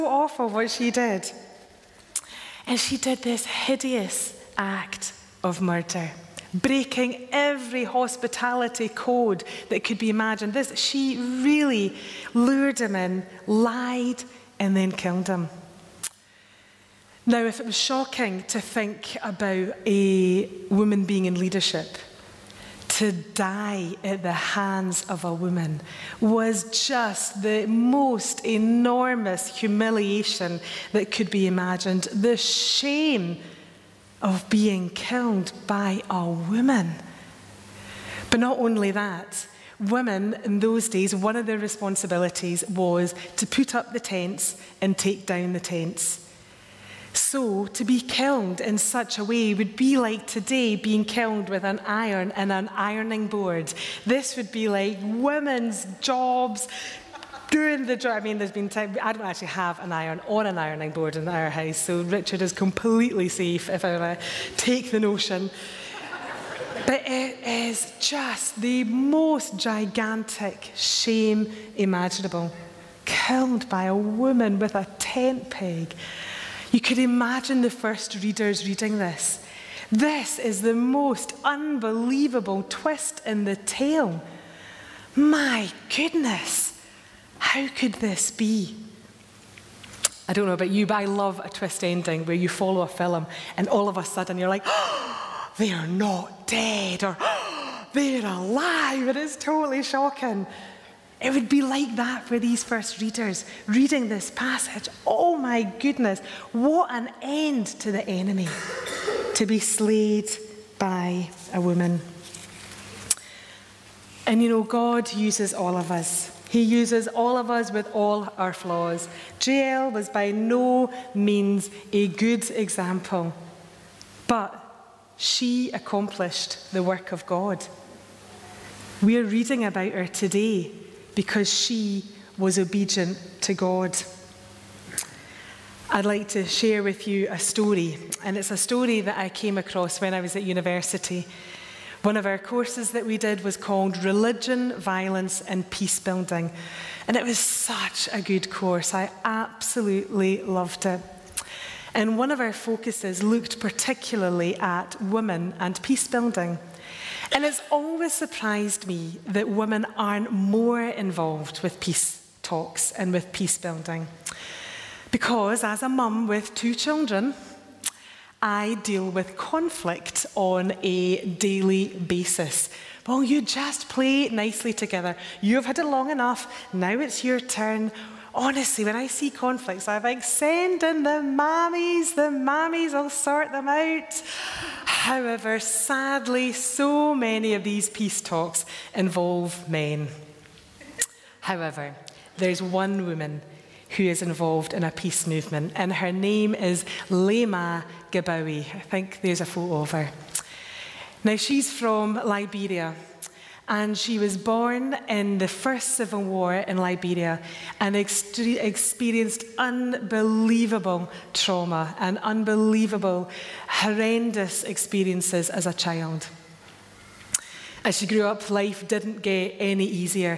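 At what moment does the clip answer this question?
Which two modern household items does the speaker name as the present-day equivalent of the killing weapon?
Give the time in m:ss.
0:51.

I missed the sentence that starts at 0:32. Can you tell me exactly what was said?
The shame of being killed by a woman.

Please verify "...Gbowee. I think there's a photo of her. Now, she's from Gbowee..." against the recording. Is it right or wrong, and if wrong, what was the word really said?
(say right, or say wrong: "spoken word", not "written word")
wrong: "Liberia", not "Gbowee".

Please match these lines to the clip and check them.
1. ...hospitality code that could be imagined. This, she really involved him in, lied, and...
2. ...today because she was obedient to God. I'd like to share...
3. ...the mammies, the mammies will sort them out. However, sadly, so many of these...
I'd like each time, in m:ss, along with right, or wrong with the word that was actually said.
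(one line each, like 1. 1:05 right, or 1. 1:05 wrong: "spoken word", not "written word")
1. 0:07 wrong: "lured", not "involved"
2. 2:10 right
3. 3:01 right.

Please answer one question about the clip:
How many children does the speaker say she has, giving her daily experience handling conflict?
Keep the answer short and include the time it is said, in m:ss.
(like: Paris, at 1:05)
2, at 2:46.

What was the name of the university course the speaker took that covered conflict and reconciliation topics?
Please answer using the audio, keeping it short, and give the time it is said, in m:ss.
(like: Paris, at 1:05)
Religion, Violence, and Peace Building, at 2:24.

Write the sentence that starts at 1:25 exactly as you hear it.
My goodness, how could this be?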